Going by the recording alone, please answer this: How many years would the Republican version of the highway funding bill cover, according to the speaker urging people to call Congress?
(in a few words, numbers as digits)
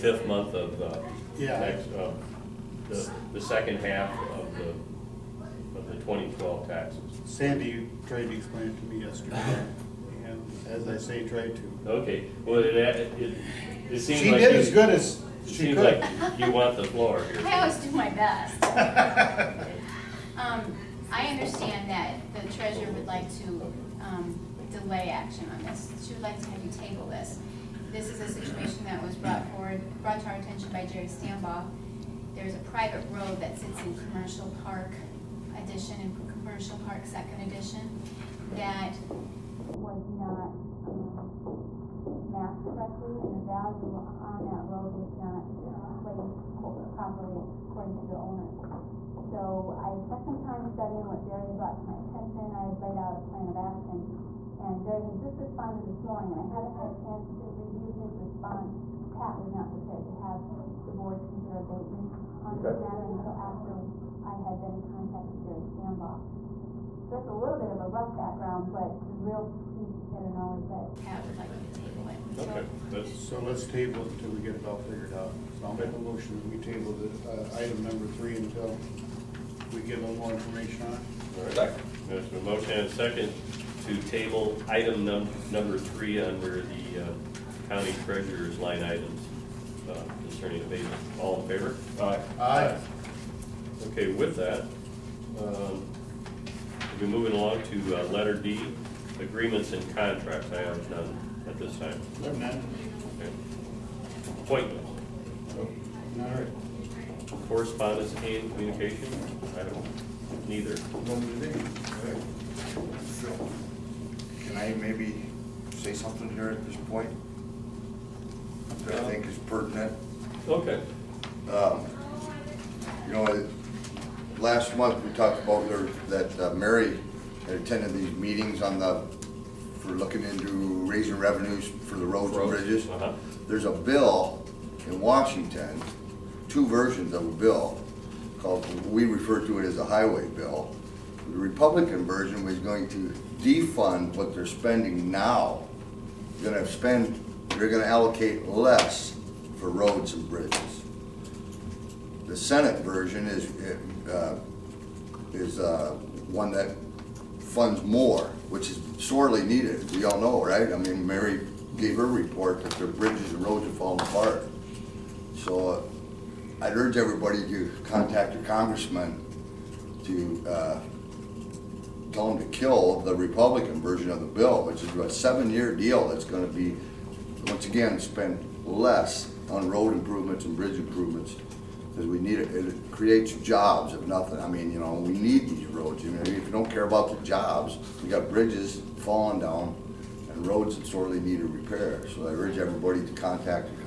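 7.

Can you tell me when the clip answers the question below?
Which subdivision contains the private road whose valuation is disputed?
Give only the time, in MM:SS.
00:34.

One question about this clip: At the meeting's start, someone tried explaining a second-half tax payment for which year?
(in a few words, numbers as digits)
2012.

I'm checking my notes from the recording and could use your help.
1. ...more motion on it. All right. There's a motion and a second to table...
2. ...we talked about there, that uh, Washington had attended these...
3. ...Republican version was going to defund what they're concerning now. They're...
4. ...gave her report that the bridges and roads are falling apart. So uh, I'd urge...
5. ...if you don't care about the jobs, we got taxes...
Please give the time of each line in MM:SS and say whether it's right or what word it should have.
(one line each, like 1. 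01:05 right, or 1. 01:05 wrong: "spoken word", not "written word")
1. 01:20 wrong: "information", not "motion"
2. 02:05 wrong: "Mary", not "Washington"
3. 02:21 wrong: "spending", not "concerning"
4. 02:41 right
5. 03:06 wrong: "bridges", not "taxes".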